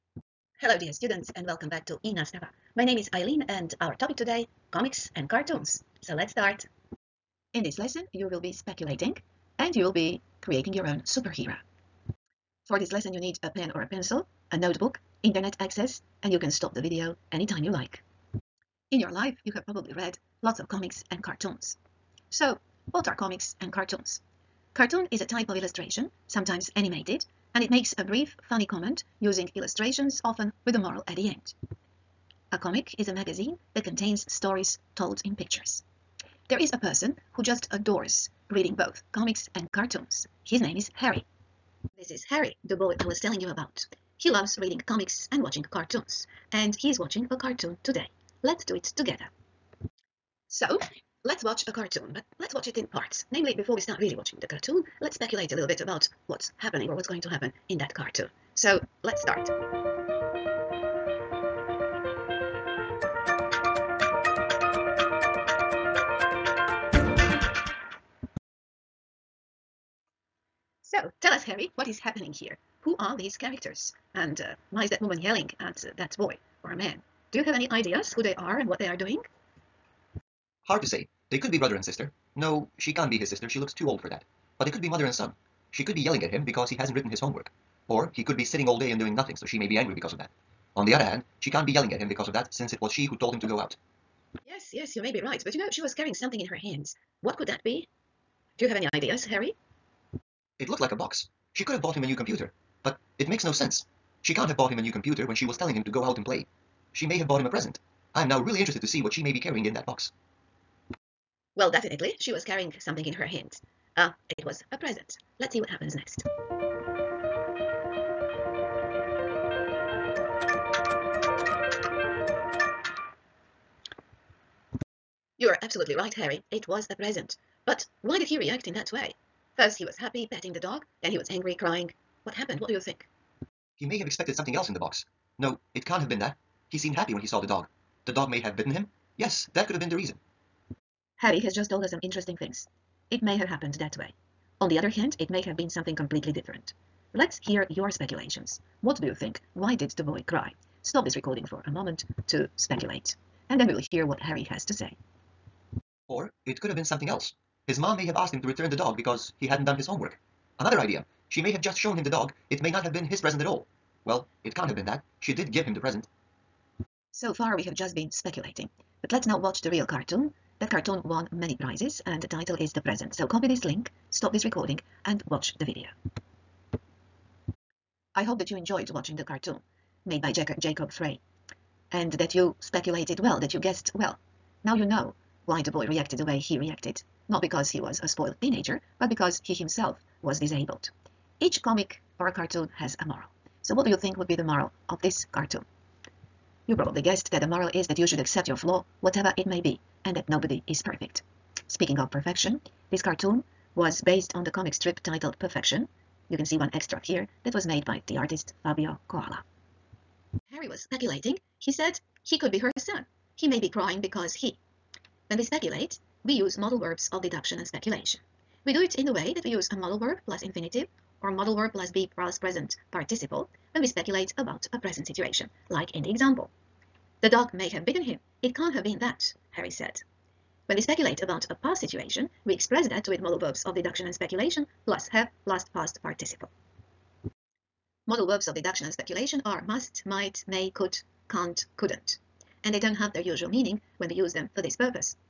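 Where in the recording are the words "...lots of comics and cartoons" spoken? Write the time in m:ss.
0:20.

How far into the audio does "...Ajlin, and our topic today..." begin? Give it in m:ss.
0:03.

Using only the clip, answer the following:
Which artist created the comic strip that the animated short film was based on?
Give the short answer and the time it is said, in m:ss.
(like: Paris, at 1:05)
Fabio Coala, at 3:28.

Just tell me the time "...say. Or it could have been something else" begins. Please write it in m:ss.
2:34.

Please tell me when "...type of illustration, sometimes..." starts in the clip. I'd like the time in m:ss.
0:25.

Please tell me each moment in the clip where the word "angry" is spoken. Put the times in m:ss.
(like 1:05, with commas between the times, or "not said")
1:29, 2:11.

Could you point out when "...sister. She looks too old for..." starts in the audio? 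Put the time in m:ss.
1:23.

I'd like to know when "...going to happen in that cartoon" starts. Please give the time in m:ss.
0:57.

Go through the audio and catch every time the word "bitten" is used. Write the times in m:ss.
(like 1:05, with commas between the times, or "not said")
2:18, 3:47.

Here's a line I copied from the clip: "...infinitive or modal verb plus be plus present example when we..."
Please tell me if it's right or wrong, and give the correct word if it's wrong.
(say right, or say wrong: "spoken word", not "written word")
wrong: "participle", not "example".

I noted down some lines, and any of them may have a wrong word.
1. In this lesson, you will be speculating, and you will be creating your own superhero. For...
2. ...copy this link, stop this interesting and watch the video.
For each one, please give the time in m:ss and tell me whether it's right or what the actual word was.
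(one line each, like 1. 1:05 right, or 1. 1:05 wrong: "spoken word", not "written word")
1. 0:07 right
2. 2:53 wrong: "recording", not "interesting".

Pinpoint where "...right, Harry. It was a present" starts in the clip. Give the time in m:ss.
2:05.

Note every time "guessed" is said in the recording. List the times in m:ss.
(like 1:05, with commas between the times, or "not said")
3:03, 3:17.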